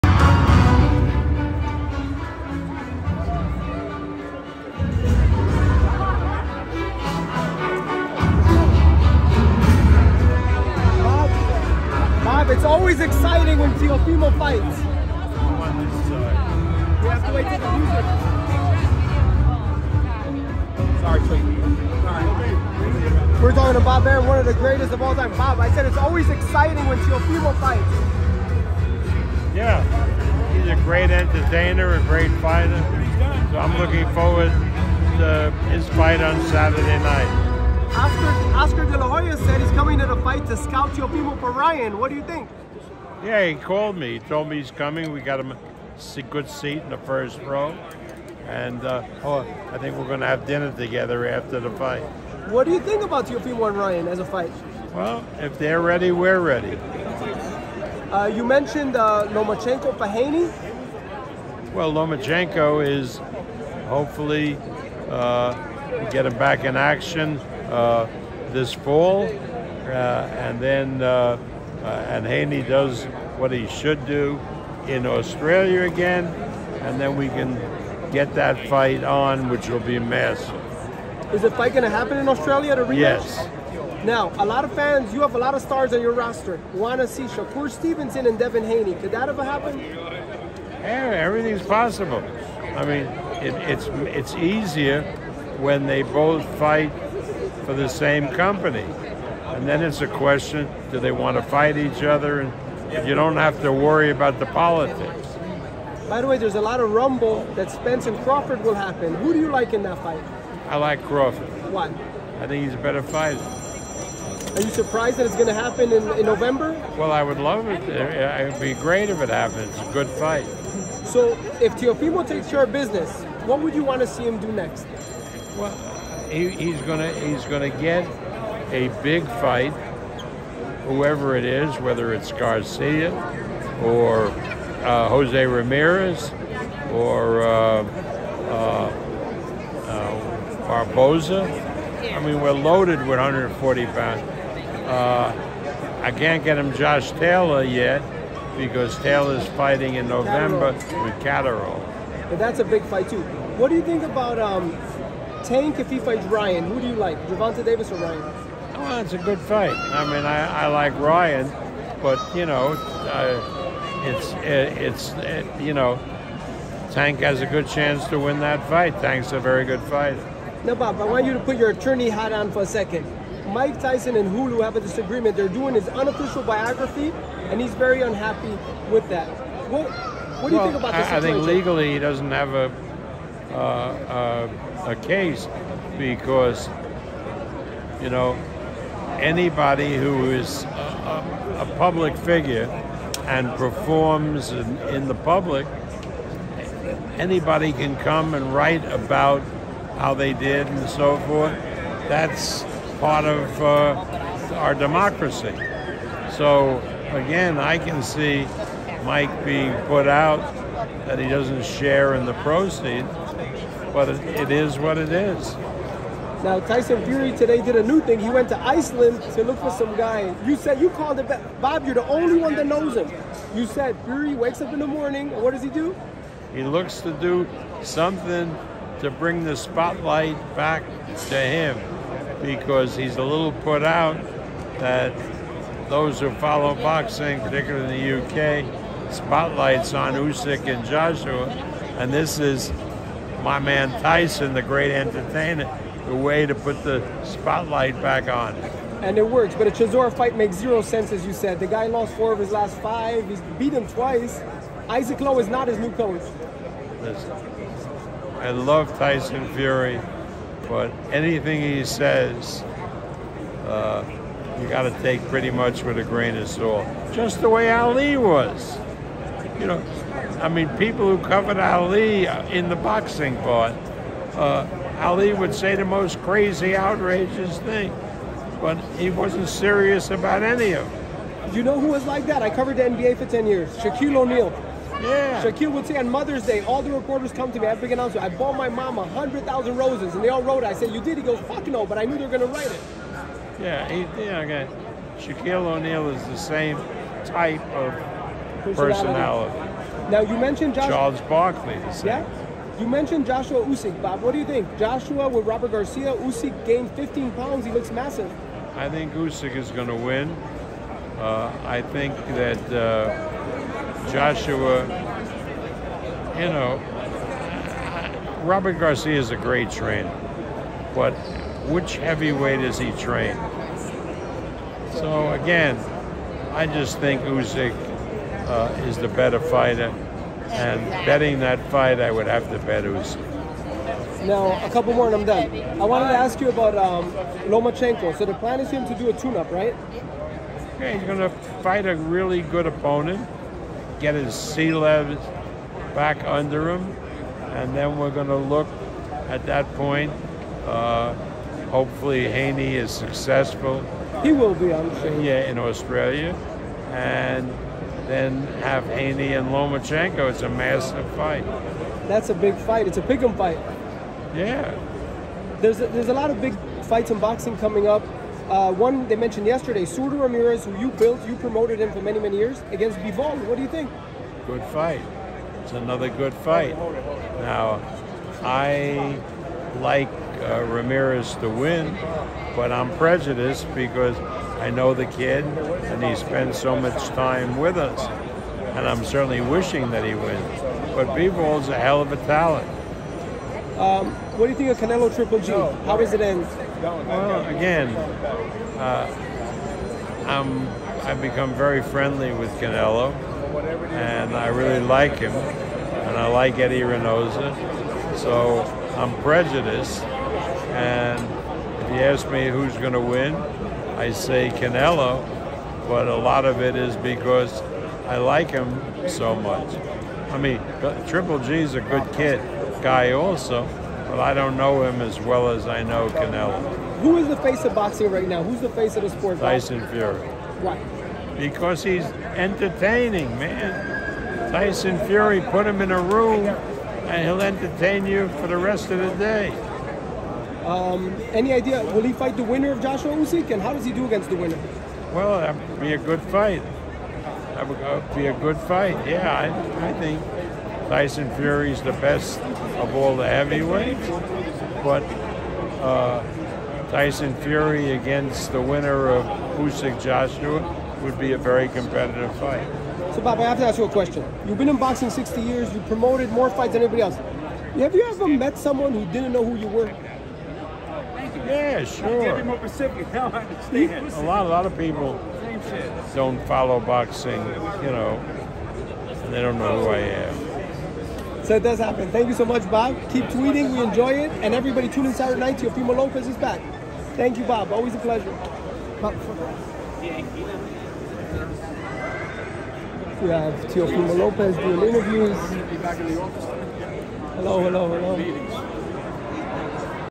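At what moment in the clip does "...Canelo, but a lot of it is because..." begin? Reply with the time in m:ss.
6:54.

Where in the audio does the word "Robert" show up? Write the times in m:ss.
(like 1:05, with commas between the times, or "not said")
5:05, 5:18.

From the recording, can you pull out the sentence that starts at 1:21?
Is the fight going to happen in Australia to rematch?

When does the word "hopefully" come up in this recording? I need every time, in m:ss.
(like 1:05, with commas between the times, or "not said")
1:03, 5:51.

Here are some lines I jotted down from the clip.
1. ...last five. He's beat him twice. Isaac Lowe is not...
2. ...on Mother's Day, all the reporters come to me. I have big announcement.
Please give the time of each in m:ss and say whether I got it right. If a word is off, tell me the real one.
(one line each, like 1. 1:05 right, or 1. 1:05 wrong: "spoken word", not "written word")
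1. 4:12 right
2. 4:45 right.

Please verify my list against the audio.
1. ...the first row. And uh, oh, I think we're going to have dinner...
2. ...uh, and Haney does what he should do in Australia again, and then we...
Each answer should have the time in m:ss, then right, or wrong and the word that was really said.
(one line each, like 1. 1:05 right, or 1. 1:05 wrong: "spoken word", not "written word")
1. 0:46 right
2. 1:11 right.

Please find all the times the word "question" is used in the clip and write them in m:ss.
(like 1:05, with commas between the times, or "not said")
1:40, 7:43.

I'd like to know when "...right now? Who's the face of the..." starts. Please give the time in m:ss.
7:08.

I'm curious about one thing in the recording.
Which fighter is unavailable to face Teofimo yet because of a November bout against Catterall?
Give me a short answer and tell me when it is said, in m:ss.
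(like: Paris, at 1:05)
Josh Taylor, at 2:26.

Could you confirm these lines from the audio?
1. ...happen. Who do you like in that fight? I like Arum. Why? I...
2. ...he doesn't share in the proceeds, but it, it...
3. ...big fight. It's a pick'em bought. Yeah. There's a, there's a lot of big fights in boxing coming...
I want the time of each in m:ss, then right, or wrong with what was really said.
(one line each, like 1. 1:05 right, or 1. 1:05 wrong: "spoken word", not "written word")
1. 1:48 wrong: "Crawford", not "Arum"
2. 3:31 right
3. 6:02 wrong: "fight", not "bought".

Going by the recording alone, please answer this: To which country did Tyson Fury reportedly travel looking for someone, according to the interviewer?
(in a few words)
Iceland.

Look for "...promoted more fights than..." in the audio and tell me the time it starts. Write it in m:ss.
7:45.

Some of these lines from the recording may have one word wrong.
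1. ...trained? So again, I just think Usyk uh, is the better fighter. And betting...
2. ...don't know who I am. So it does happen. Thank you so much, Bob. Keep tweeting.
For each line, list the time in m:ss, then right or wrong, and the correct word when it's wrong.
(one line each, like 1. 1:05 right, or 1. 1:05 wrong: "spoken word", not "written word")
1. 5:22 right
2. 7:59 right.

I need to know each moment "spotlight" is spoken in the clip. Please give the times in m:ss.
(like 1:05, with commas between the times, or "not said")
3:49, 3:59, 4:07.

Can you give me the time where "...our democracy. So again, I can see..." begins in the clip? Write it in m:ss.
3:24.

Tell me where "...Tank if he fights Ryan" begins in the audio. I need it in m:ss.
2:35.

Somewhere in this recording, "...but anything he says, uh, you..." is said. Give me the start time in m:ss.
4:20.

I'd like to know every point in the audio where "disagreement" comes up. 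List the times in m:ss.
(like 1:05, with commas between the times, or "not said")
2:54.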